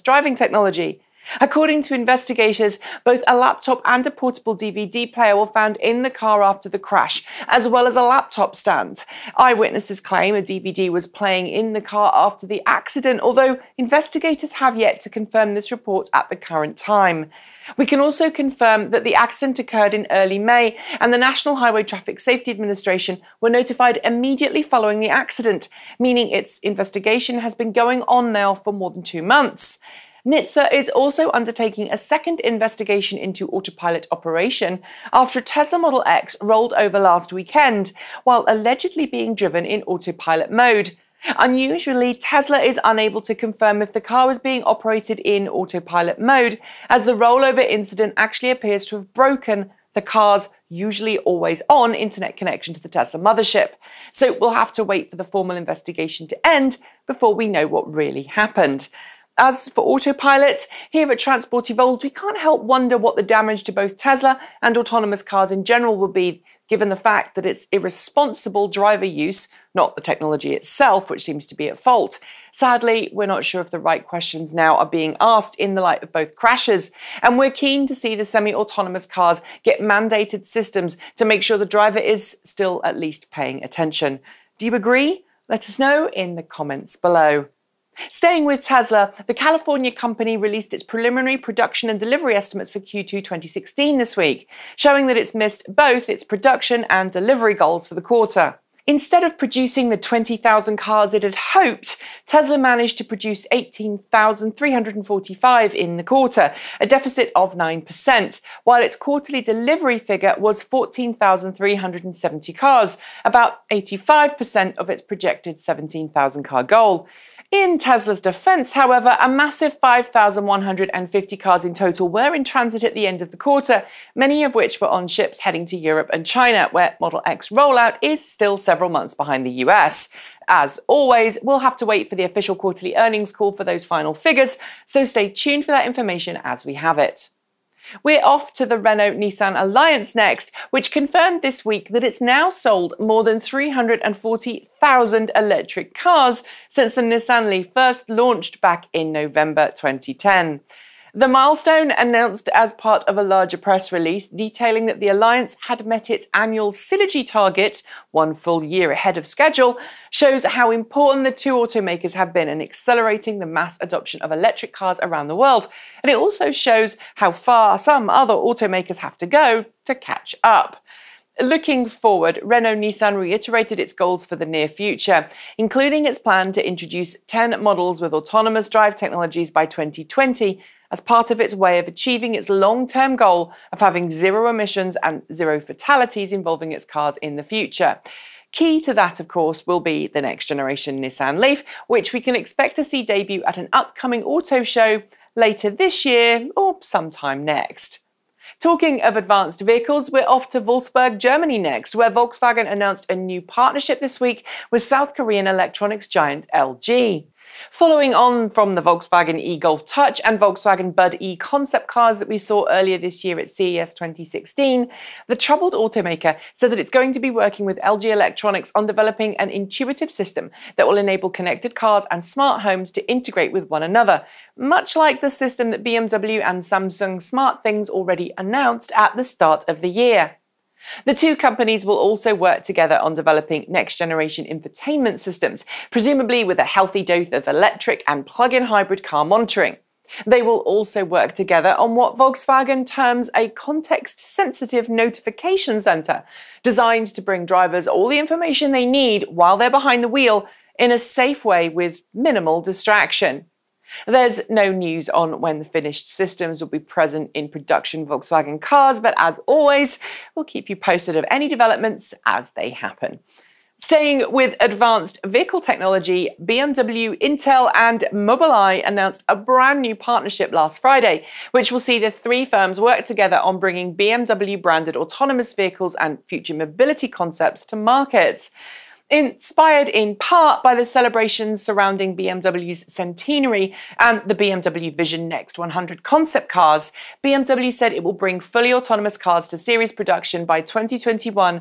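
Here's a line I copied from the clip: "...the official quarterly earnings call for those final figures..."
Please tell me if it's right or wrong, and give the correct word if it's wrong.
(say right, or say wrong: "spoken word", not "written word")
right.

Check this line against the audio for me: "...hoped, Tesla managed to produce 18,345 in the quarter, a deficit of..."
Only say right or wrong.
right.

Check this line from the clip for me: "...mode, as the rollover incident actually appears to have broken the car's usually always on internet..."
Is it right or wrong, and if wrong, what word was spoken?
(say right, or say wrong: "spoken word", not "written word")
right.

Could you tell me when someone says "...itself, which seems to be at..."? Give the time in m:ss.
1:10.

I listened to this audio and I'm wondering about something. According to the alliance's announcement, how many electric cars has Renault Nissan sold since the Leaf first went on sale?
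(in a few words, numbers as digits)
340,000.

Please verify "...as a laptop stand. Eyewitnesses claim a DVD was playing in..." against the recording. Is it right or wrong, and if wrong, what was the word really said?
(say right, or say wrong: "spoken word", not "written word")
right.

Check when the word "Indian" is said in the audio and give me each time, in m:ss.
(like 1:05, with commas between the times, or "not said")
not said.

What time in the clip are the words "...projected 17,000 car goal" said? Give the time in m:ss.
1:55.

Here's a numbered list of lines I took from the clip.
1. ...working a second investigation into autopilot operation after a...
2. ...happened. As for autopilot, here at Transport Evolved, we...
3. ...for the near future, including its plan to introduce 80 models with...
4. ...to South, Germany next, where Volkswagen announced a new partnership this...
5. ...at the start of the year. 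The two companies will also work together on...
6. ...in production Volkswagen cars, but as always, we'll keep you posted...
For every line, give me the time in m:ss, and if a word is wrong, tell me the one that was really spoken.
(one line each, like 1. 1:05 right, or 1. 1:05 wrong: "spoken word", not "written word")
1. 0:31 wrong: "undertaking", not "working"
2. 0:58 right
3. 2:54 wrong: "10", not "80"
4. 3:20 wrong: "Wolfsburg", not "South"
5. 3:48 right
6. 4:17 right.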